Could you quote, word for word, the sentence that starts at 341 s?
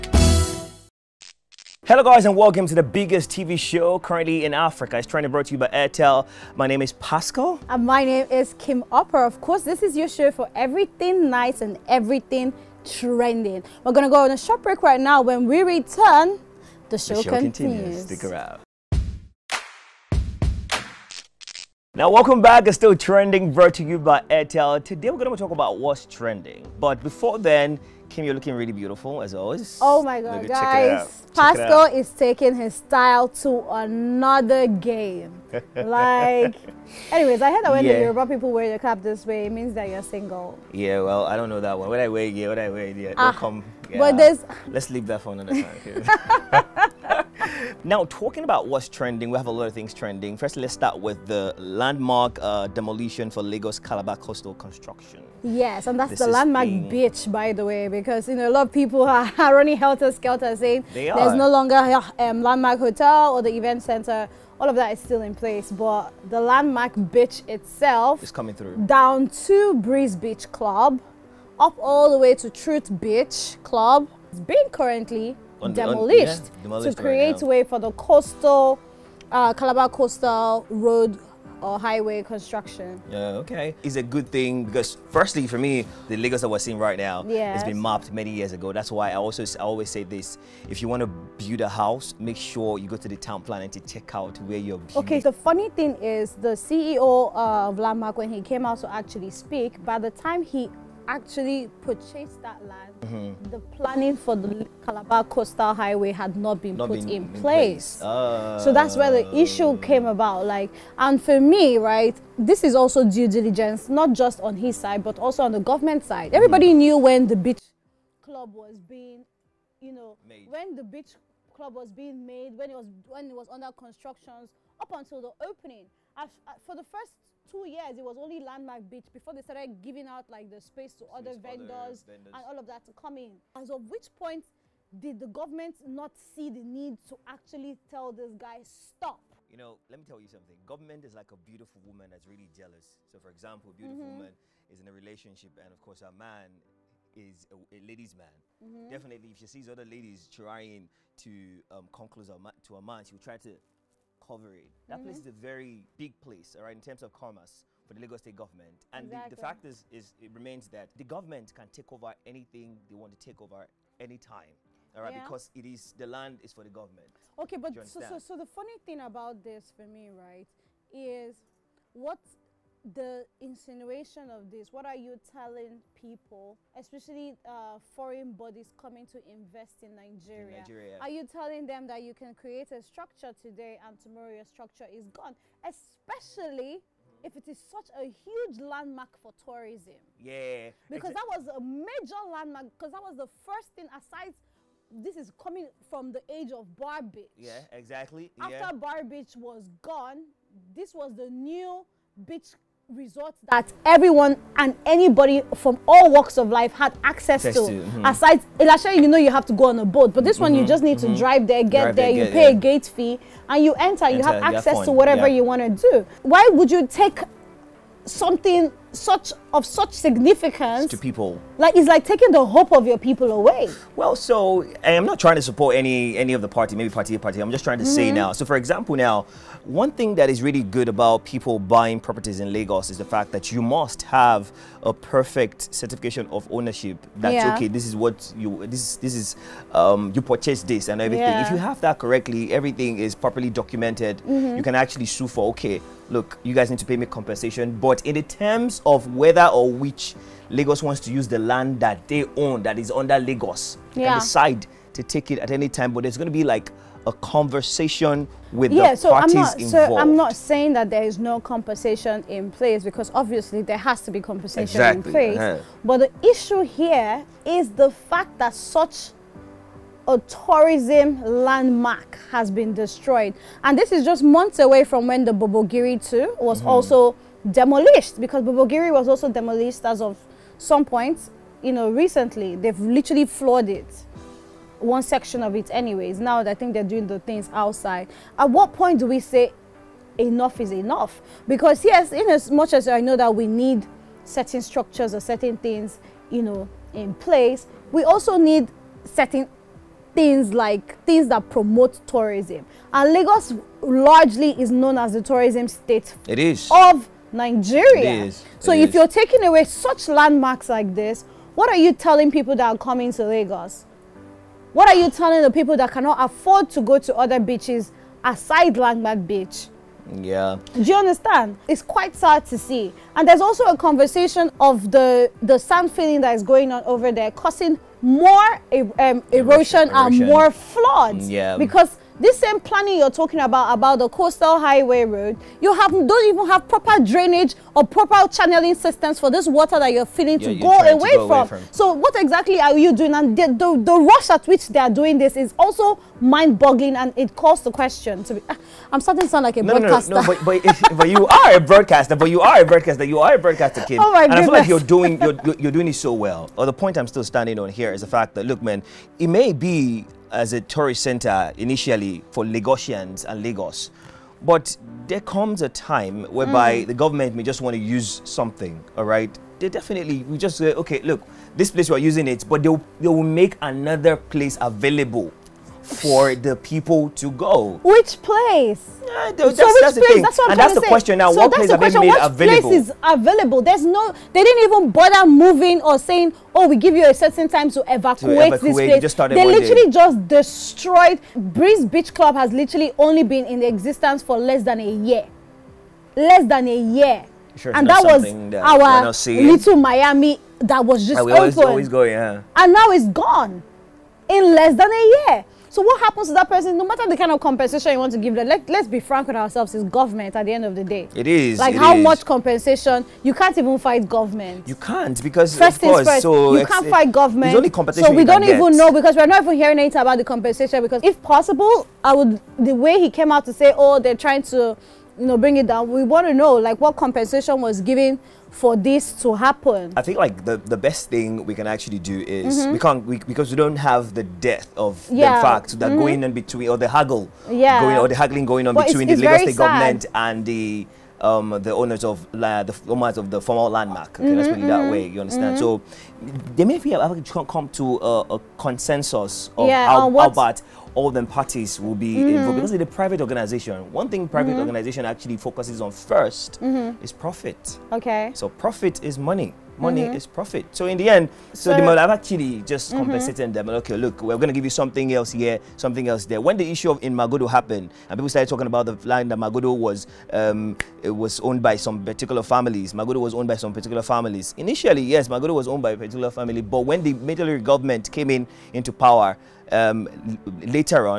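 So what exactly are you doing?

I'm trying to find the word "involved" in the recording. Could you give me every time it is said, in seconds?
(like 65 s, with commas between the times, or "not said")
259 s, 452 s.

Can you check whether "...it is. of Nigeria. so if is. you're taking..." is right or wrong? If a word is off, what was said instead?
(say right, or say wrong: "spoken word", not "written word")
right.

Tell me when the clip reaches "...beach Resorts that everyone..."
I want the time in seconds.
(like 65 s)
202 s.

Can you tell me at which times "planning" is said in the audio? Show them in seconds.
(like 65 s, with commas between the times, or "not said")
93 s, 103 s, 332 s.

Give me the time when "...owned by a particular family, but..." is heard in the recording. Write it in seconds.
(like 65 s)
475 s.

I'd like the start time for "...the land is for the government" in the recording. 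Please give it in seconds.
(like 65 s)
166 s.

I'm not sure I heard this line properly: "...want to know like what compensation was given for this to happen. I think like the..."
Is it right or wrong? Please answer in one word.
right.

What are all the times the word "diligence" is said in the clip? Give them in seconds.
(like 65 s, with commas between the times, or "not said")
113 s.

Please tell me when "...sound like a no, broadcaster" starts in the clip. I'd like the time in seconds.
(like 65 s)
349 s.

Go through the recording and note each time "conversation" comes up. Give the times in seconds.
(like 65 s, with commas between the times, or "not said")
257 s, 323 s.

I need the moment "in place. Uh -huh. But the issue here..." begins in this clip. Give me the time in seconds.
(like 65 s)
265 s.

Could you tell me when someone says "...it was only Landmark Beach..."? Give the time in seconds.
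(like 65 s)
127 s.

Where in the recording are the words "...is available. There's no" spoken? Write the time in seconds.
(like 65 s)
382 s.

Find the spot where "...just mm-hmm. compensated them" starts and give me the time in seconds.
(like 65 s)
462 s.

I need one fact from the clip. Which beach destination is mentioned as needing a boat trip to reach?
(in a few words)
Ilashe.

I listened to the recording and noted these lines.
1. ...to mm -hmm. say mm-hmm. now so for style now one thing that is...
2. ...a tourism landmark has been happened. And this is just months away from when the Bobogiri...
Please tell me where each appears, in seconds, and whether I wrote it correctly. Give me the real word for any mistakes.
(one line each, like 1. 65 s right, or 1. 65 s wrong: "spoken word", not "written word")
1. 227 s wrong: "example", not "style"
2. 270 s wrong: "destroyed", not "happened".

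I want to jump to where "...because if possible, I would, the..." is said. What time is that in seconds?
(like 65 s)
420 s.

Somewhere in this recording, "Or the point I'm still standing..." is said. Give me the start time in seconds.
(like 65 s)
356 s.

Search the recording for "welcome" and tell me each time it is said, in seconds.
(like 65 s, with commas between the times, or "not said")
2 s, 22 s.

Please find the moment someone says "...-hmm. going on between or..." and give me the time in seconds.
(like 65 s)
435 s.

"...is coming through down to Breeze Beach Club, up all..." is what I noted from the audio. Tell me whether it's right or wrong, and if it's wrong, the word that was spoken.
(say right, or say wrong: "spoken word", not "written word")
right.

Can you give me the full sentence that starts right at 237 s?
okay this is what you this this is um, you purchase this and everything yeah.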